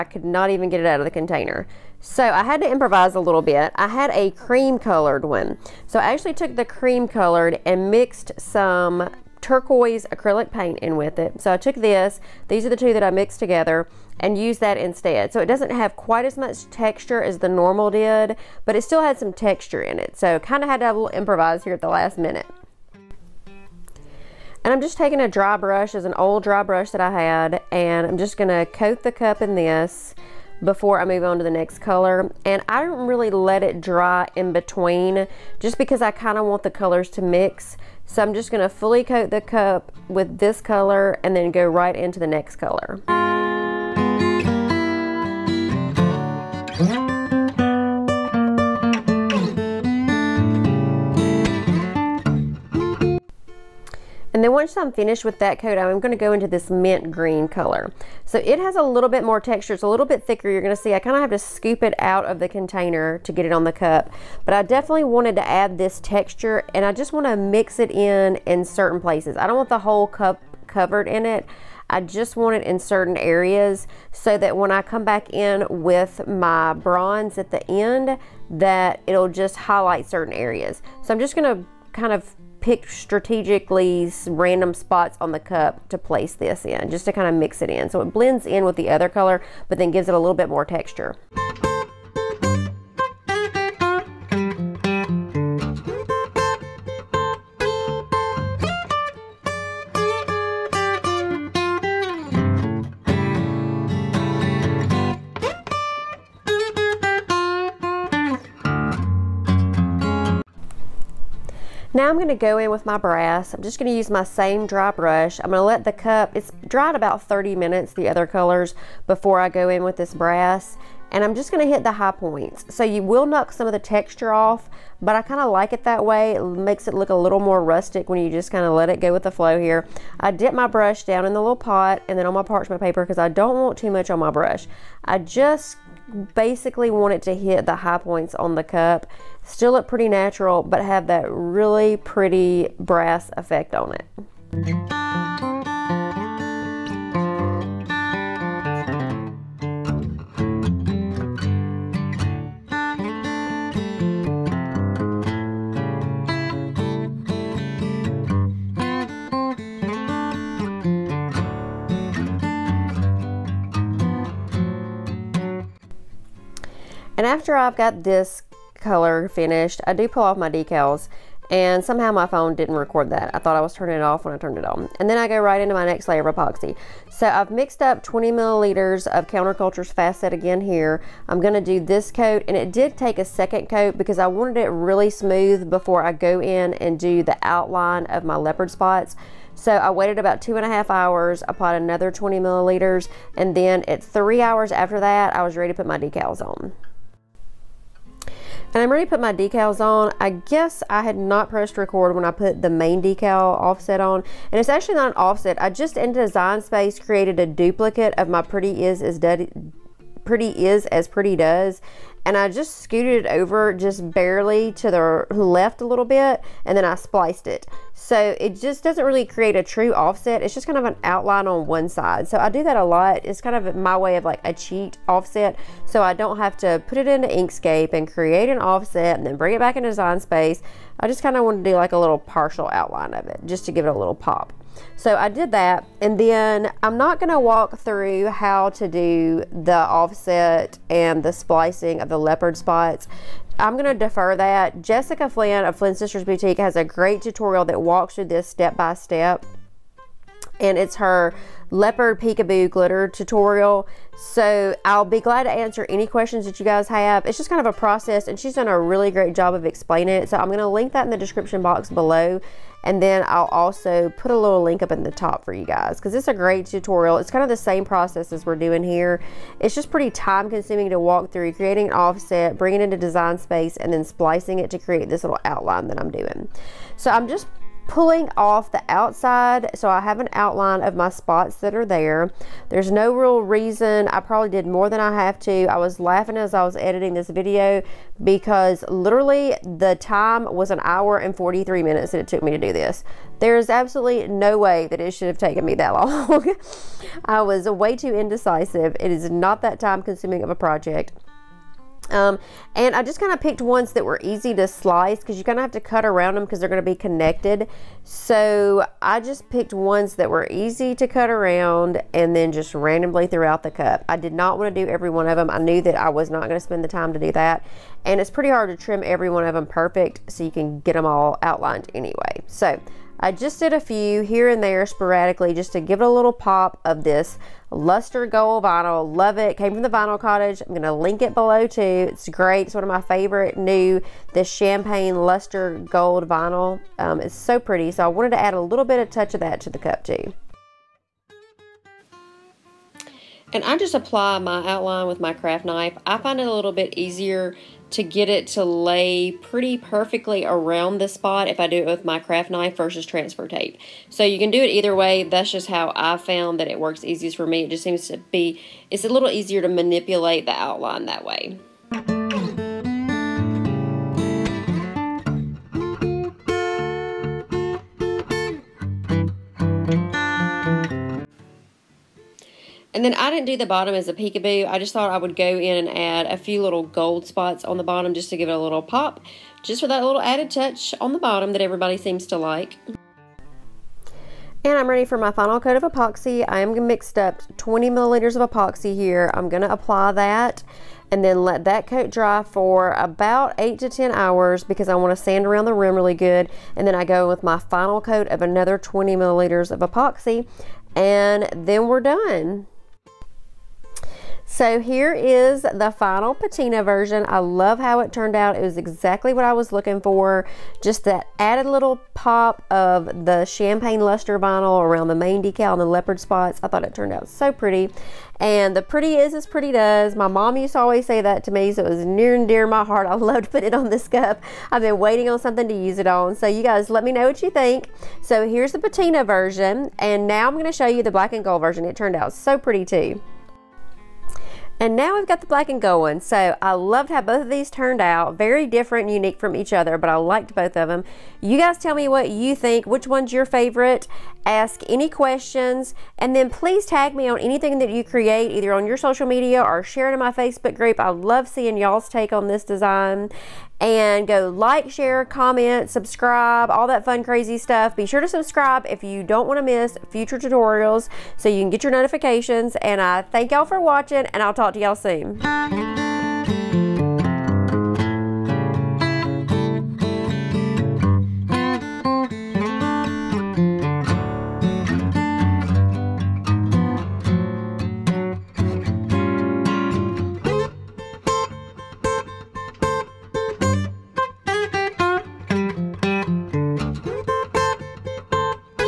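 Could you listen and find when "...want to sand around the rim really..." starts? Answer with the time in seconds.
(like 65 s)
394 s.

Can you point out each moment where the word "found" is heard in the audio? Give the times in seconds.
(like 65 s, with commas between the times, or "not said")
356 s.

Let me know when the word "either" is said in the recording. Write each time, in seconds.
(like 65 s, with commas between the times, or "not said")
354 s, 448 s.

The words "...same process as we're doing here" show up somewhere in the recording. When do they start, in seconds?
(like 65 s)
267 s.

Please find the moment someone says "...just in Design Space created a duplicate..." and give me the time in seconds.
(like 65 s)
205 s.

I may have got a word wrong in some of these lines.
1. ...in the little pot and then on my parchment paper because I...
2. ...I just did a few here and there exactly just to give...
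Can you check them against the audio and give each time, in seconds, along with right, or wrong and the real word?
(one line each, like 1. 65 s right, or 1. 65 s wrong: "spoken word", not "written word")
1. 131 s right
2. 323 s wrong: "sporadically", not "exactly".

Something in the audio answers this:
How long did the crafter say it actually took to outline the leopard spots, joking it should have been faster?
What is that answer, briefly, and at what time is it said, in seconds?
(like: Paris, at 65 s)
1 hour 43 minutes, at 290 s.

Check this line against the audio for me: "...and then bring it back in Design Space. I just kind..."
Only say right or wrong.
right.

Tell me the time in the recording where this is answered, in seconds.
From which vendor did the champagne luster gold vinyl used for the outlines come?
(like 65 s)
329 s.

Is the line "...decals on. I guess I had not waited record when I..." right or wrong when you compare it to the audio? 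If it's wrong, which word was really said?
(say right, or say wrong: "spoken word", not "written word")
wrong: "pressed", not "waited".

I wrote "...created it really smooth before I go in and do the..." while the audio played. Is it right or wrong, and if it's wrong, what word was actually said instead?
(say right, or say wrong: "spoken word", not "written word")
wrong: "wanted", not "created".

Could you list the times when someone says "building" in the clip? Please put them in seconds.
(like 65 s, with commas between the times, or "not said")
not said.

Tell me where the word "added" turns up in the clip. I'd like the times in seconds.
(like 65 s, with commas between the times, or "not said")
380 s, 411 s.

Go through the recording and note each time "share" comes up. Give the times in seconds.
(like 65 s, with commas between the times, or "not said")
449 s, 454 s.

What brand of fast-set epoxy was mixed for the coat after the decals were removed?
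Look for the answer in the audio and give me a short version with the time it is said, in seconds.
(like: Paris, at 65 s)
Counterculture, at 179 s.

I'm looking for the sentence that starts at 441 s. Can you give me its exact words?
You guys tell me what you think, which one's your favorite.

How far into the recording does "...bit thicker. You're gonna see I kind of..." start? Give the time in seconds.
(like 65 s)
60 s.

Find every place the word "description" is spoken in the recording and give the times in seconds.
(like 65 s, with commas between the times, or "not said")
261 s.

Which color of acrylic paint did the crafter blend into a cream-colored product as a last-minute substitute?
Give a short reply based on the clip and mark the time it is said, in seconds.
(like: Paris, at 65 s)
Turquoise, at 9 s.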